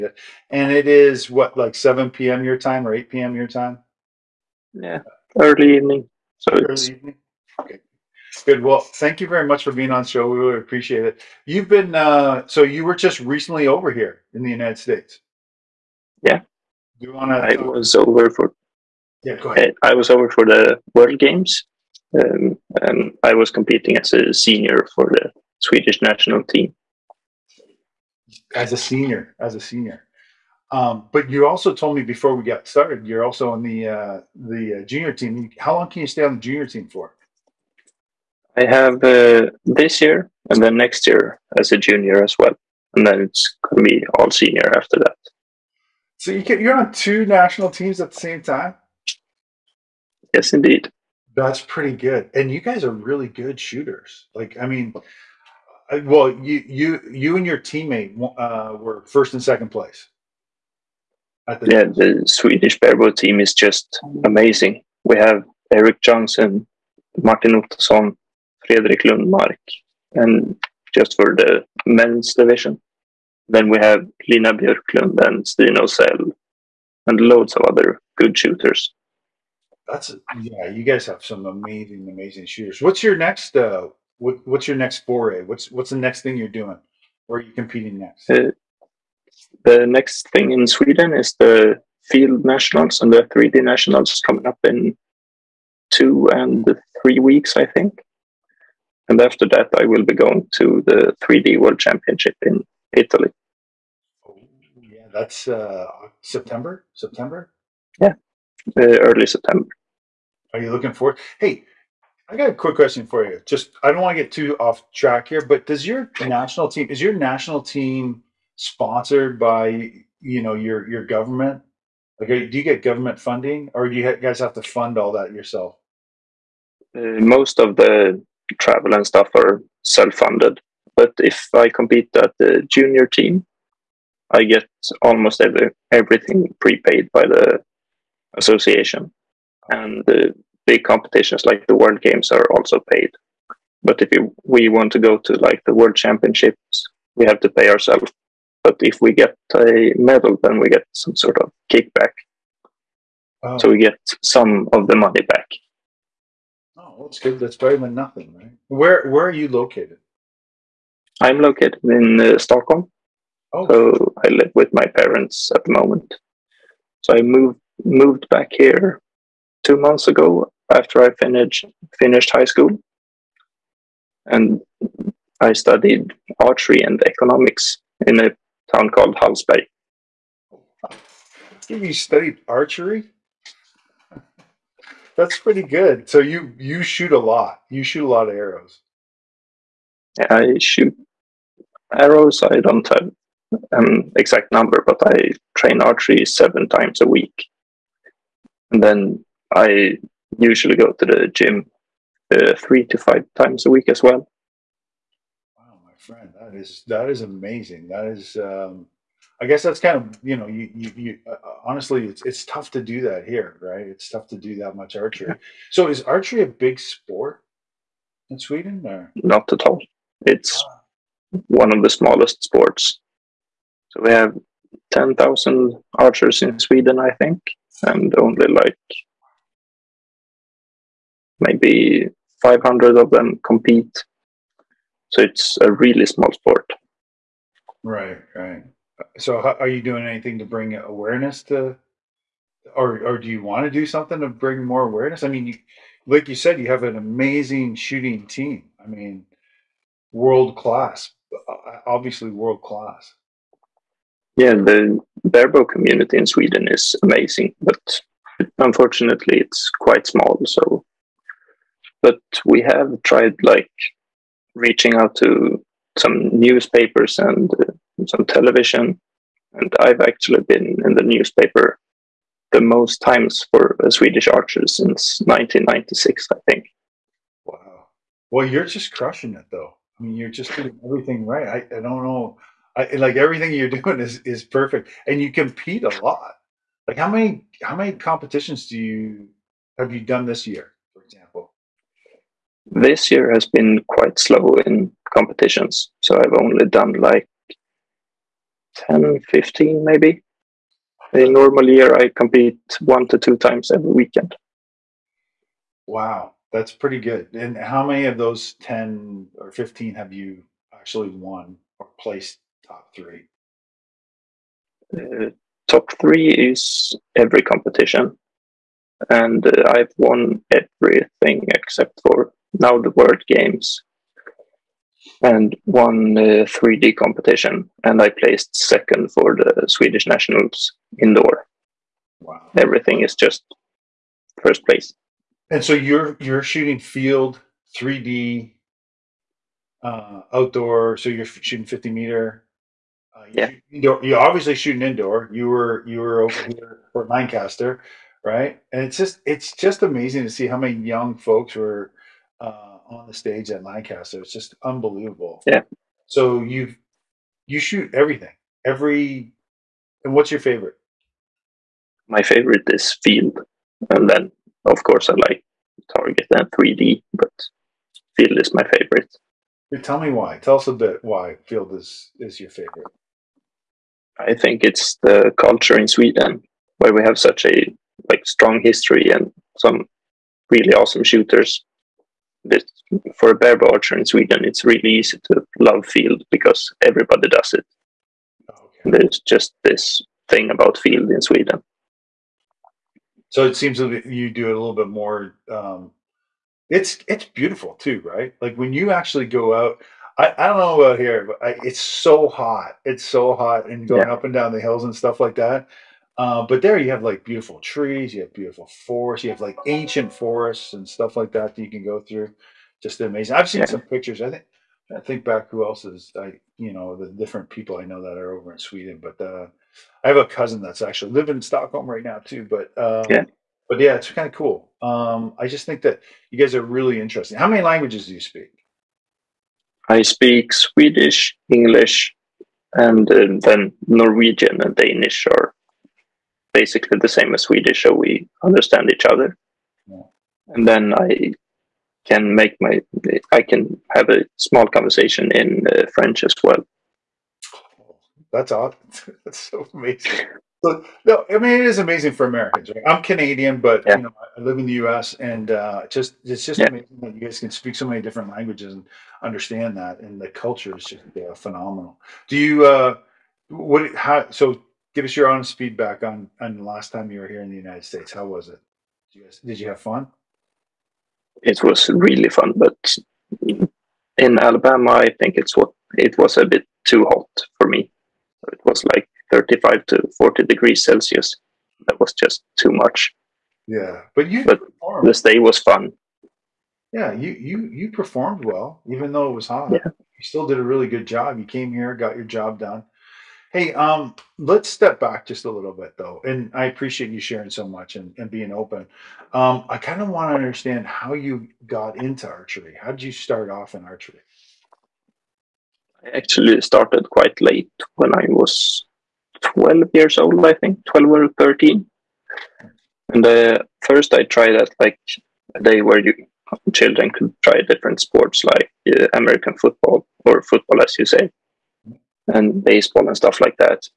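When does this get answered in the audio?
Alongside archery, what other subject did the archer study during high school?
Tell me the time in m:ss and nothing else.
2:57.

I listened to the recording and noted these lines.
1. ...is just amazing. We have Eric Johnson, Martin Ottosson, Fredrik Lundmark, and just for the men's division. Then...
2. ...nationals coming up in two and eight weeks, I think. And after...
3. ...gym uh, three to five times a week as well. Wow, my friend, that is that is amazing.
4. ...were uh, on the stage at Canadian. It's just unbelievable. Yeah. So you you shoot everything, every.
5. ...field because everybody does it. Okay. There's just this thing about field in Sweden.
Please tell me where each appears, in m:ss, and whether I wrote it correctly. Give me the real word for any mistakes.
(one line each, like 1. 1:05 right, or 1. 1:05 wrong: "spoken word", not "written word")
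1. 1:03 right
2. 1:33 wrong: "three", not "eight"
3. 3:21 right
4. 5:51 wrong: "Lancaster", not "Canadian"
5. 6:25 right.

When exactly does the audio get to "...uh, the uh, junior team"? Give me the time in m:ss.
0:33.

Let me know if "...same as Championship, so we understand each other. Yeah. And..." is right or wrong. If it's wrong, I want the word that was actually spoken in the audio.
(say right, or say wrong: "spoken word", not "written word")
wrong: "Swedish", not "Championship".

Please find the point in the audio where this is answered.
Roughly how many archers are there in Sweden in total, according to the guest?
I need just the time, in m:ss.
3:44.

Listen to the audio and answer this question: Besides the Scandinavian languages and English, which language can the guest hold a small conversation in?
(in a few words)
French.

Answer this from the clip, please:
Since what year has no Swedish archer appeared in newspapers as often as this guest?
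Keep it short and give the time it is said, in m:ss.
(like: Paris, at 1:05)
1996, at 4:35.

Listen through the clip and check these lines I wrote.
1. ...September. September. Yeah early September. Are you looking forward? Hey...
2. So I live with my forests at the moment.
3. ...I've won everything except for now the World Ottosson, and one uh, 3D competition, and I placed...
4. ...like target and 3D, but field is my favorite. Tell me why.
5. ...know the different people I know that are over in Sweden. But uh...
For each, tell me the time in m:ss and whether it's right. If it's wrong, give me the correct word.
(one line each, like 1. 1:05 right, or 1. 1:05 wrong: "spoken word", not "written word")
1. 1:46 right
2. 2:43 wrong: "parents", not "forests"
3. 5:19 wrong: "Games", not "Ottosson"
4. 6:05 right
5. 6:56 right.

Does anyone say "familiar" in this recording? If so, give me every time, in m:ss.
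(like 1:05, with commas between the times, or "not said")
not said.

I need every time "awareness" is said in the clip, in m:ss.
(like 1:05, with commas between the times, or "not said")
4:00, 4:04.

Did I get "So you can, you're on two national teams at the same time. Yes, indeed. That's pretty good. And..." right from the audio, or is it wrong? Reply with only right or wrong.
right.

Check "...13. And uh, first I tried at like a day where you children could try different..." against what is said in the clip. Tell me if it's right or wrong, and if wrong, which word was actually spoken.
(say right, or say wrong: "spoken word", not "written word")
right.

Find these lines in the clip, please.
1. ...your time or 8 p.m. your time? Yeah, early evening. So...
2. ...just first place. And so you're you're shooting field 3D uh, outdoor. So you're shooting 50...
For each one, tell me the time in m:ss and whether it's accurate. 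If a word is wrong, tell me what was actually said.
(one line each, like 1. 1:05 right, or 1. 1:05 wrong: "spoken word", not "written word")
1. 0:02 right
2. 5:33 right.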